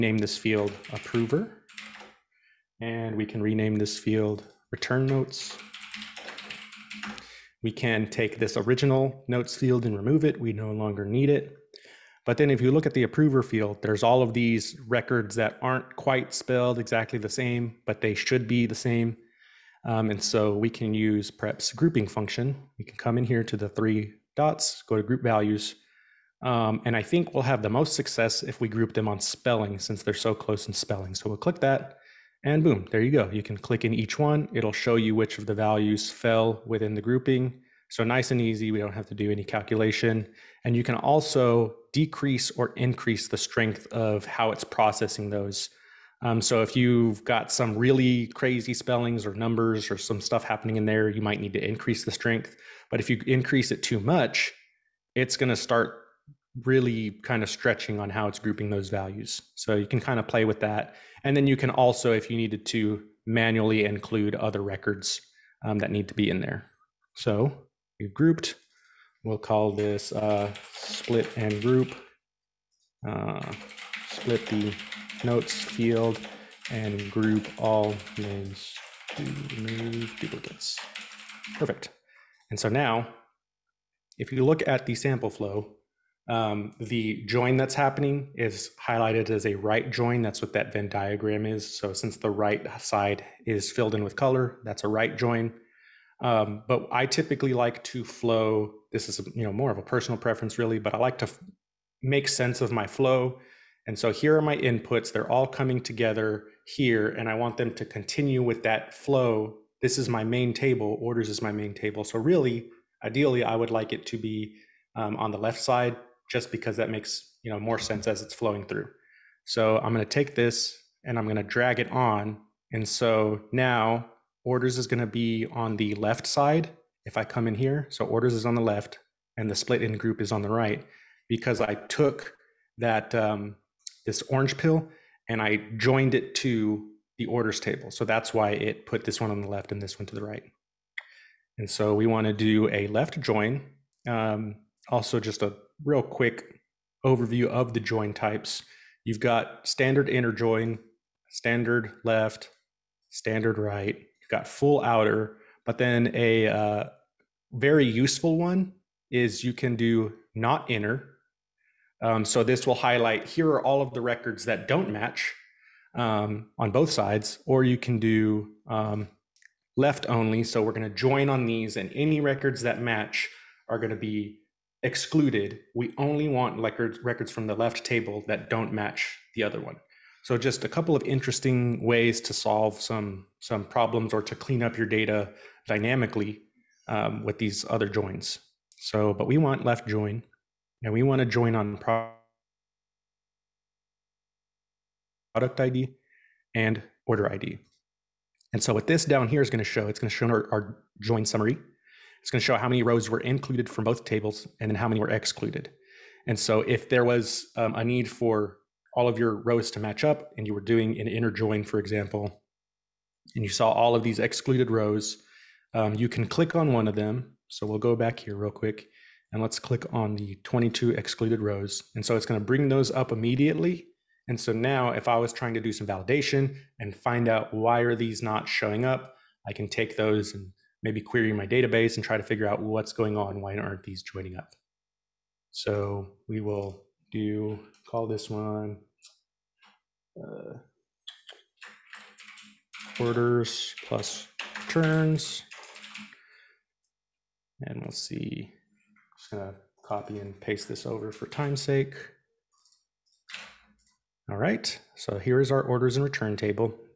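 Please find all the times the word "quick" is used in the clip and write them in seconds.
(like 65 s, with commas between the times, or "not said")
146 s, 218 s.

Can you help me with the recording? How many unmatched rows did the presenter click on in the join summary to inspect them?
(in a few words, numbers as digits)
22.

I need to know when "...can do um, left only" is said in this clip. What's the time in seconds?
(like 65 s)
167 s.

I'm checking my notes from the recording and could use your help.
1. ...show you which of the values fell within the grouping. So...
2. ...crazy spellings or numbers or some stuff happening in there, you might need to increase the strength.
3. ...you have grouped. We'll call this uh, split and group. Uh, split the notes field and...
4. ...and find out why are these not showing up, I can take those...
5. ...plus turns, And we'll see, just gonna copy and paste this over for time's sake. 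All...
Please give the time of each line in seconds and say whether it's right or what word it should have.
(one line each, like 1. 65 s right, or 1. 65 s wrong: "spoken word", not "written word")
1. 34 s right
2. 48 s right
3. 67 s right
4. 226 s right
5. 243 s right.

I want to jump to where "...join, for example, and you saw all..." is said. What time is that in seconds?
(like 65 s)
211 s.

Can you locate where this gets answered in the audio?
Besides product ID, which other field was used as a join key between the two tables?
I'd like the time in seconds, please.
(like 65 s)
197 s.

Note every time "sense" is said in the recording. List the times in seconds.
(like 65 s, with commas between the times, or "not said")
102 s, 117 s.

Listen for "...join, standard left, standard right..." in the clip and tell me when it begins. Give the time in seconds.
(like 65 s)
150 s.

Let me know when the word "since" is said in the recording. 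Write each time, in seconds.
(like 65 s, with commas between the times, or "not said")
29 s, 91 s.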